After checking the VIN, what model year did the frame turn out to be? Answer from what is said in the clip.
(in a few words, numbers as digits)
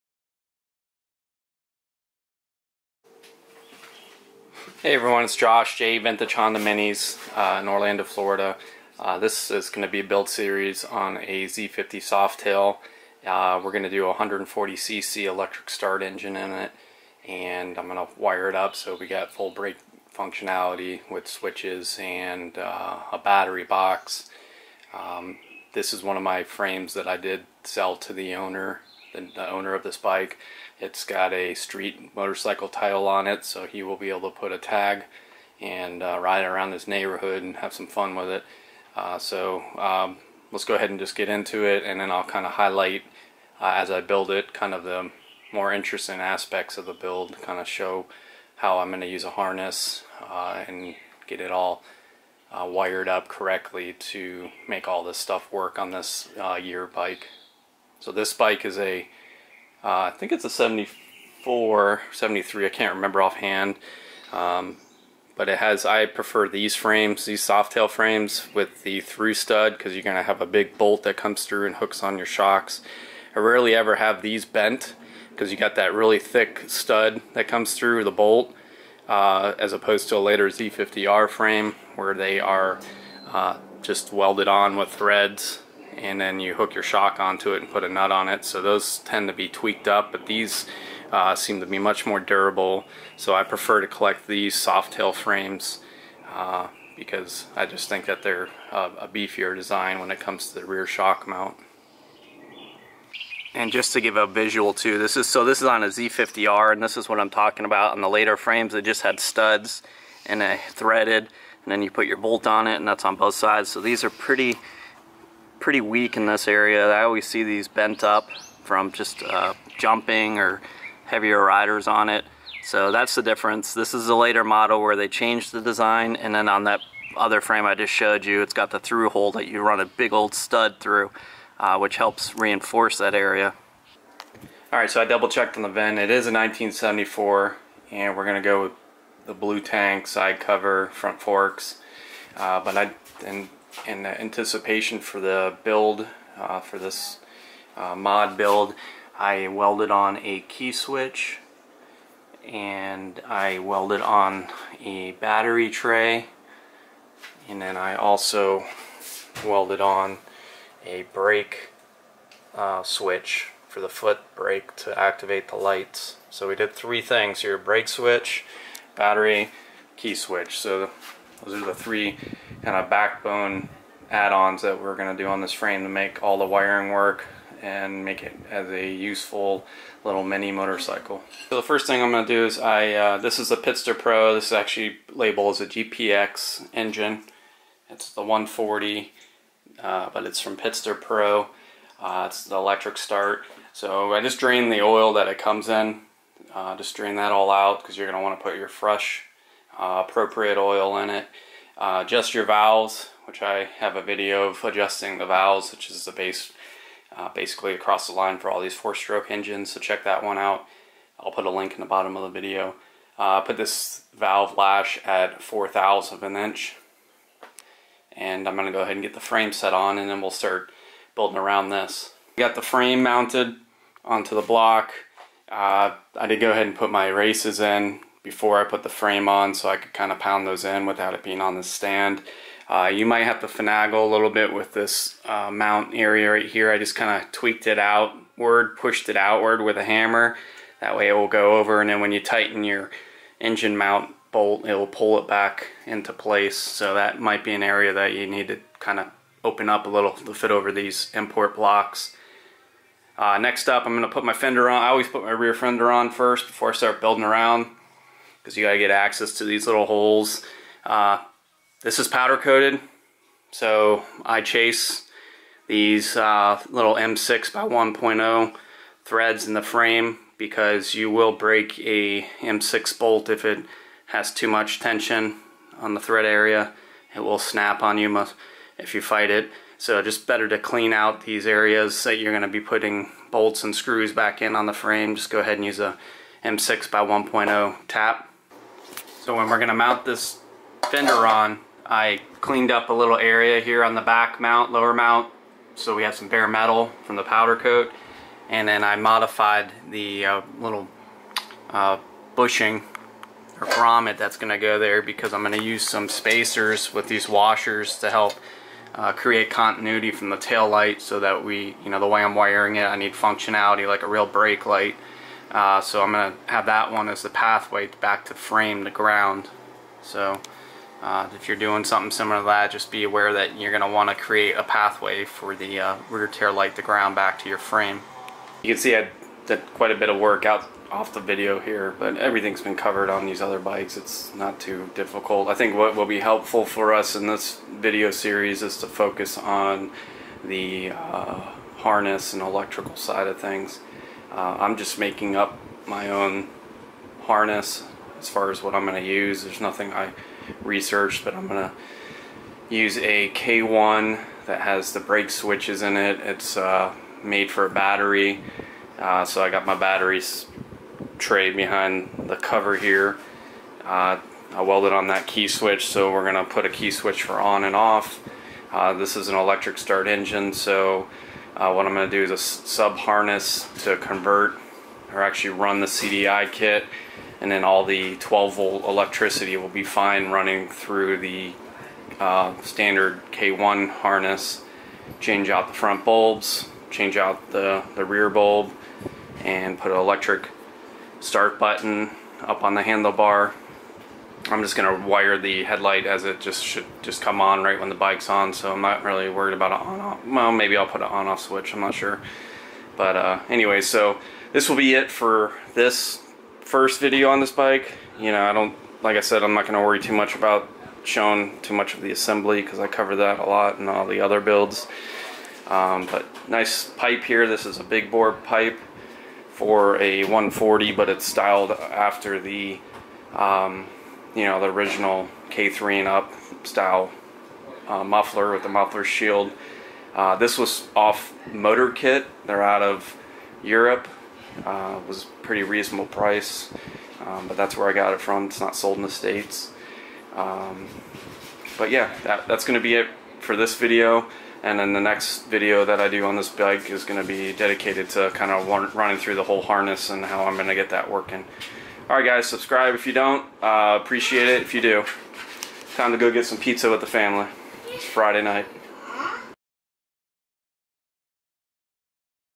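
1974.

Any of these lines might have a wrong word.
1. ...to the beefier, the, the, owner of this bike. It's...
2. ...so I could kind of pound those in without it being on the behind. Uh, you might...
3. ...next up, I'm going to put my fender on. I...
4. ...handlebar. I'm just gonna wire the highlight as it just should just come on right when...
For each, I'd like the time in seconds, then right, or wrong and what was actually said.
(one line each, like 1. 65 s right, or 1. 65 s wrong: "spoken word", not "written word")
1. 27 s wrong: "owner", not "beefier"
2. 229 s wrong: "stand", not "behind"
3. 253 s right
4. 392 s wrong: "headlight", not "highlight".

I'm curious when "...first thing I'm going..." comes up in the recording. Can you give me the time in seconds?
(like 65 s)
181 s.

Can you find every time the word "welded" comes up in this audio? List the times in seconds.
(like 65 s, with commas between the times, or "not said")
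84 s, 149 s, 153 s, 159 s, 364 s.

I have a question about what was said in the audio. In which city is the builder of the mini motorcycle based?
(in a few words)
Orlando, Florida.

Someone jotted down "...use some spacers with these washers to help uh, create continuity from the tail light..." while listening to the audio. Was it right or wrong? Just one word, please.
right.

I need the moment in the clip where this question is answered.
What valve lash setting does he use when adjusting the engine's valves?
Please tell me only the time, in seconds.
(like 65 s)
215 s.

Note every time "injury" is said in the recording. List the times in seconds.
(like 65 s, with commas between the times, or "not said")
not said.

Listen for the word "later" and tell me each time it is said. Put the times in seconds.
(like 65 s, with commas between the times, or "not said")
80 s, 108 s, 124 s.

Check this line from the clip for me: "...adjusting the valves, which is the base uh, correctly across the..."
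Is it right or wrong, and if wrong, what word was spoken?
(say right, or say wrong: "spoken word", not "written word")
wrong: "basically", not "correctly".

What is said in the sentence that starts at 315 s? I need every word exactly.
Uh, so I'm going to have that one as the pathway back to frame, the ground.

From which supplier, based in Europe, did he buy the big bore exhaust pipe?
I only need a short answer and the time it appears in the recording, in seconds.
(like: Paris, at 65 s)
Motor Kit, at 431 s.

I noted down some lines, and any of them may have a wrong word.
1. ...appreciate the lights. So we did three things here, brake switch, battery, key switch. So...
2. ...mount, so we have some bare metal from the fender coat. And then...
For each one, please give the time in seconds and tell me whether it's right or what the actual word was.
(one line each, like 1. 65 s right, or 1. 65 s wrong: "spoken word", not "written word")
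1. 164 s wrong: "activate", not "appreciate"
2. 294 s wrong: "powder", not "fender".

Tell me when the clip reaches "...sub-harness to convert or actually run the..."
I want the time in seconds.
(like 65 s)
372 s.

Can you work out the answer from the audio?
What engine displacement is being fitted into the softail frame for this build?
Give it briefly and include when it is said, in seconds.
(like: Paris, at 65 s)
140cc, at 14 s.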